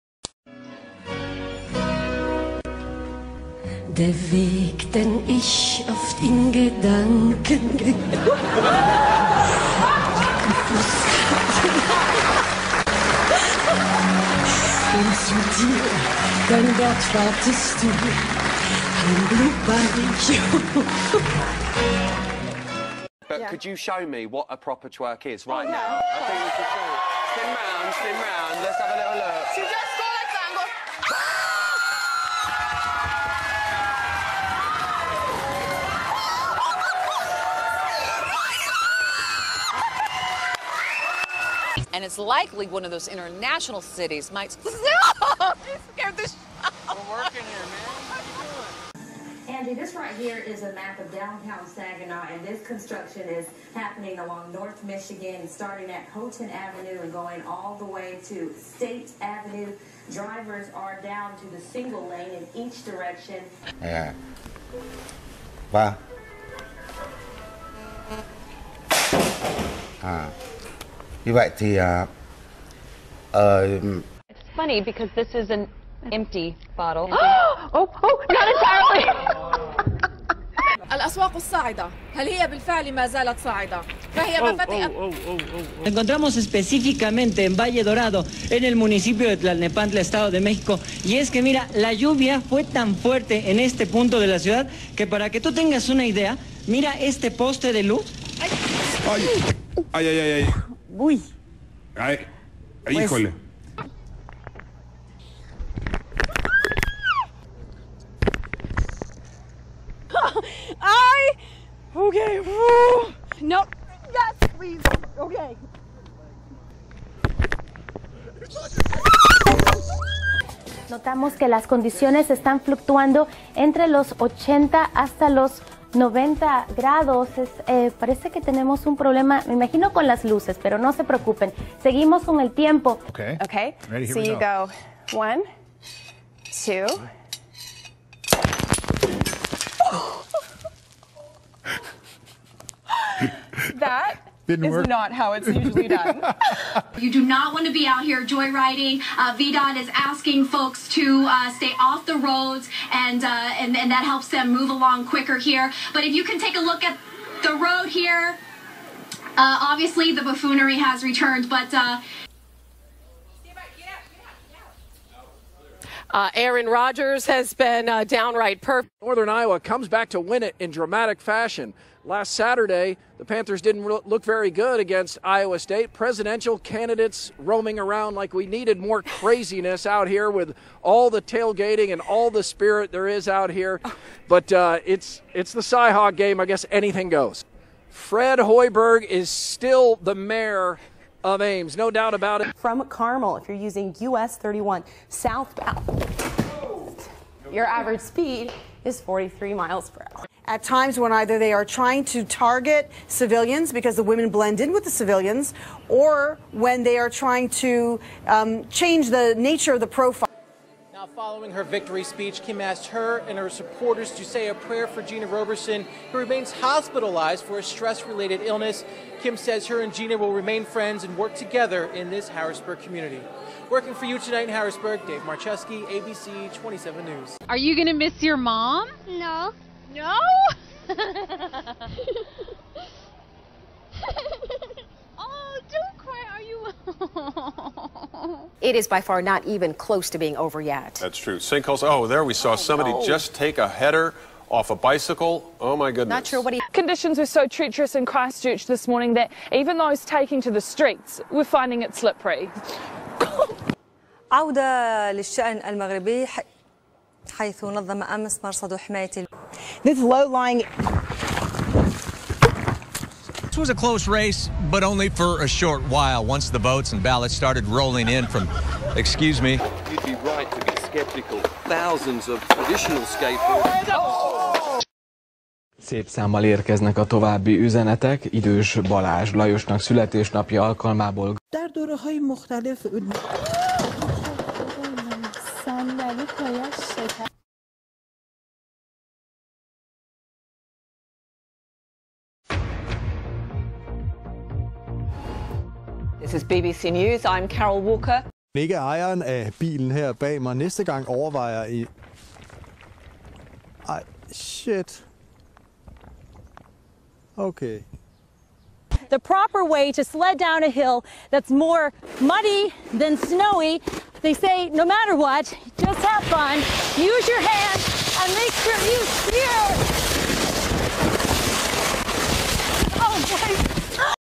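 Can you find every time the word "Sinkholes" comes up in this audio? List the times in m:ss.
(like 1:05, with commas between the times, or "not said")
4:01.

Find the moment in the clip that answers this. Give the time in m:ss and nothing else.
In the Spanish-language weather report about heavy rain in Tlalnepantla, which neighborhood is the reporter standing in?
1:27.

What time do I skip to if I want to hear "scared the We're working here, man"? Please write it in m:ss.
0:45.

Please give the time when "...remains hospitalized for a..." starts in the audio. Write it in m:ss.
3:36.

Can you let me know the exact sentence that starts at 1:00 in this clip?
Drivers are down to the single lane in each direction.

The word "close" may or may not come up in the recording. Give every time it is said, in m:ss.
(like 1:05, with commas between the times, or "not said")
3:59, 4:23.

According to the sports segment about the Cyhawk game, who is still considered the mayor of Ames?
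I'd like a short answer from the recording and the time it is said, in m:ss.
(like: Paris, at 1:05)
Fred Hoiberg, at 3:07.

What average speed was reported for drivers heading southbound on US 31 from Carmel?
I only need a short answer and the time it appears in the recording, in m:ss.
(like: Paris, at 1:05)
43 miles per hour, at 3:18.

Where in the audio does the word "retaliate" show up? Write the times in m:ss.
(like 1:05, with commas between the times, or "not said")
not said.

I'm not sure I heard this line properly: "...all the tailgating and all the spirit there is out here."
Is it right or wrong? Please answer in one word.
right.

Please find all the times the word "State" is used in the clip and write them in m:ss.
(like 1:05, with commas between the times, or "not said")
0:58, 2:55.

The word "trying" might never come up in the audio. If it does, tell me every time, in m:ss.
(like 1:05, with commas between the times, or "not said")
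3:21, 3:27.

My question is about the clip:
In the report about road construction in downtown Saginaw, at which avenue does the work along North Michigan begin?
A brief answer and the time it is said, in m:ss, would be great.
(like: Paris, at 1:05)
Houghton Avenue, at 0:56.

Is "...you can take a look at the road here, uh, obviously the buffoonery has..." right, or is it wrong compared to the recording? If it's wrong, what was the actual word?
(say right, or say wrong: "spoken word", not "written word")
right.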